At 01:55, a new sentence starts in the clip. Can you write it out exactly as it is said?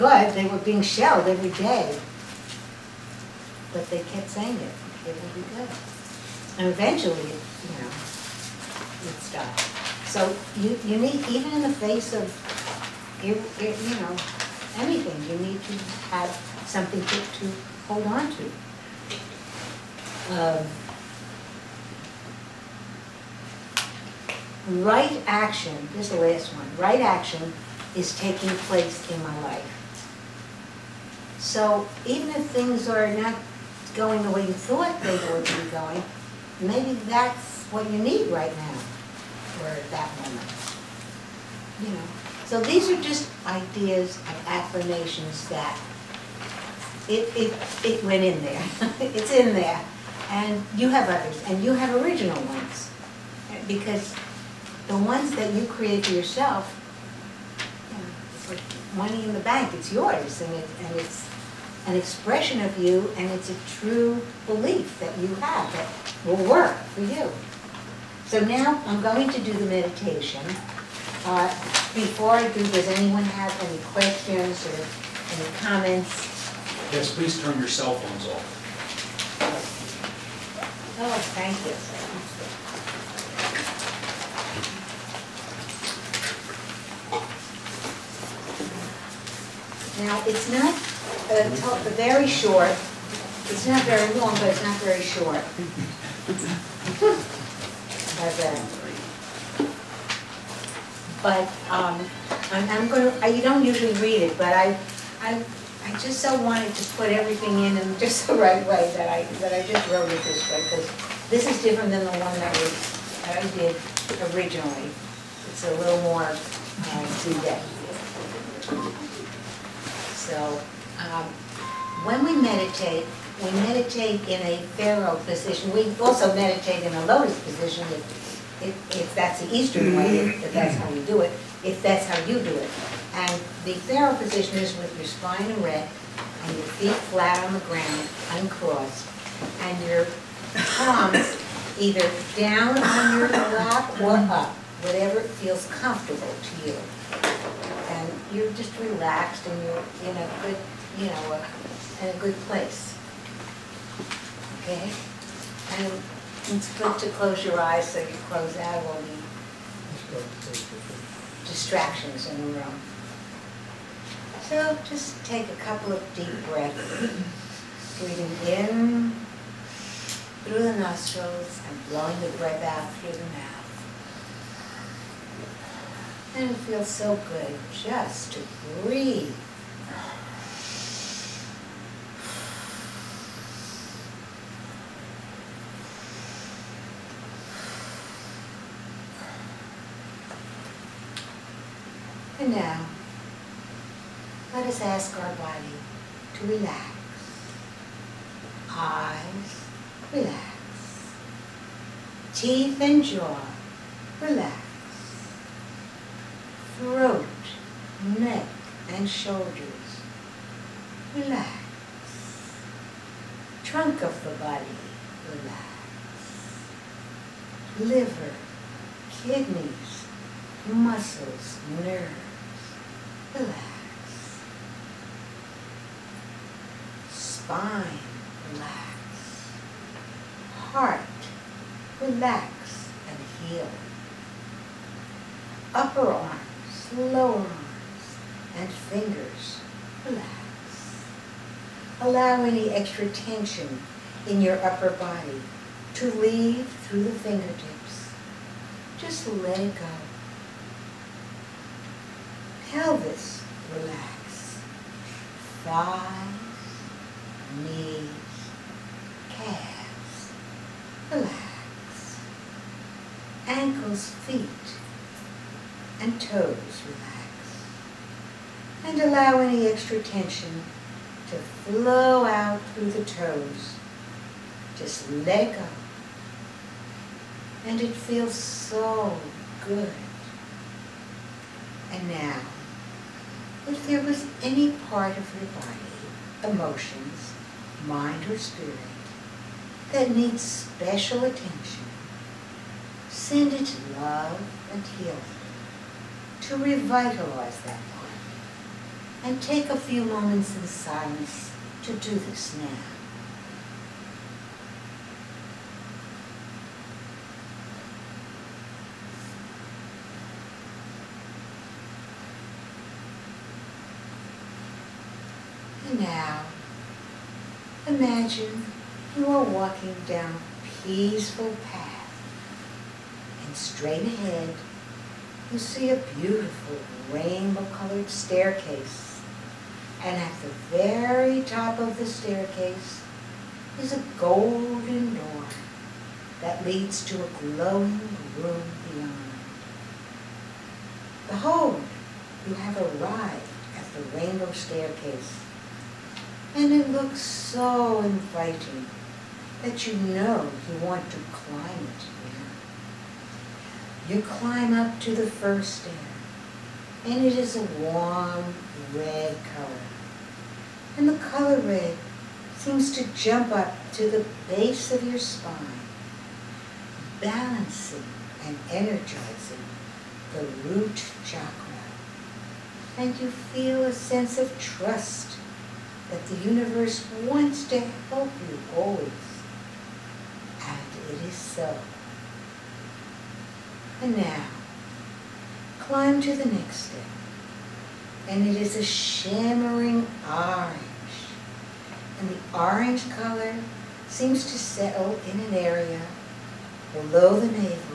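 It's a little more uh, today.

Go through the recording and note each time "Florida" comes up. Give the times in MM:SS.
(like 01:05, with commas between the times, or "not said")
not said.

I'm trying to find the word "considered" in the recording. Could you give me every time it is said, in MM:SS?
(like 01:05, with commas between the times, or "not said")
not said.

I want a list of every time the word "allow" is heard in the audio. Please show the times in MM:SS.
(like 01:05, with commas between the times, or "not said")
04:02, 04:29.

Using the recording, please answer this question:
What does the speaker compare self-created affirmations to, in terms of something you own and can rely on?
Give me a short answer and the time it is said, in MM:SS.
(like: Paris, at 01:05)
Money in the bank, at 00:58.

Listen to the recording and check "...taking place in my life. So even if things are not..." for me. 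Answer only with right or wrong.
right.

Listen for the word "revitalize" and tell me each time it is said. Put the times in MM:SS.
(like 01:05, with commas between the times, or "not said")
04:56.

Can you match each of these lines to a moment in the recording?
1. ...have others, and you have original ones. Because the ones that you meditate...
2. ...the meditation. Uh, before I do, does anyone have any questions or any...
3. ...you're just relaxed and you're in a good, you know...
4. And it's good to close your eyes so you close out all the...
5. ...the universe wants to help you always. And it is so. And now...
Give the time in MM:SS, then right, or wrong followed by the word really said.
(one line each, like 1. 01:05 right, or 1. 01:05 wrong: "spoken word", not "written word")
1. 00:50 wrong: "create", not "meditate"
2. 01:09 right
3. 02:28 right
4. 02:35 right
5. 06:16 right.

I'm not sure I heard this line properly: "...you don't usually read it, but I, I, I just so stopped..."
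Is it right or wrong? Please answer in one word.
wrong.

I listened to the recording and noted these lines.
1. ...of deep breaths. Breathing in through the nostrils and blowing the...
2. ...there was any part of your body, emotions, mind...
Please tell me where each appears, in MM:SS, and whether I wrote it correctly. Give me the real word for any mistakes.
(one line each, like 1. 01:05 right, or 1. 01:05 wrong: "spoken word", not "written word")
1. 02:45 right
2. 04:43 right.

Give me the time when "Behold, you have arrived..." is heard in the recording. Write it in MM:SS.
05:41.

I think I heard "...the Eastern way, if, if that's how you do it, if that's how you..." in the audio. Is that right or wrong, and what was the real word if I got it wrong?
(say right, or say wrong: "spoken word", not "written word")
right.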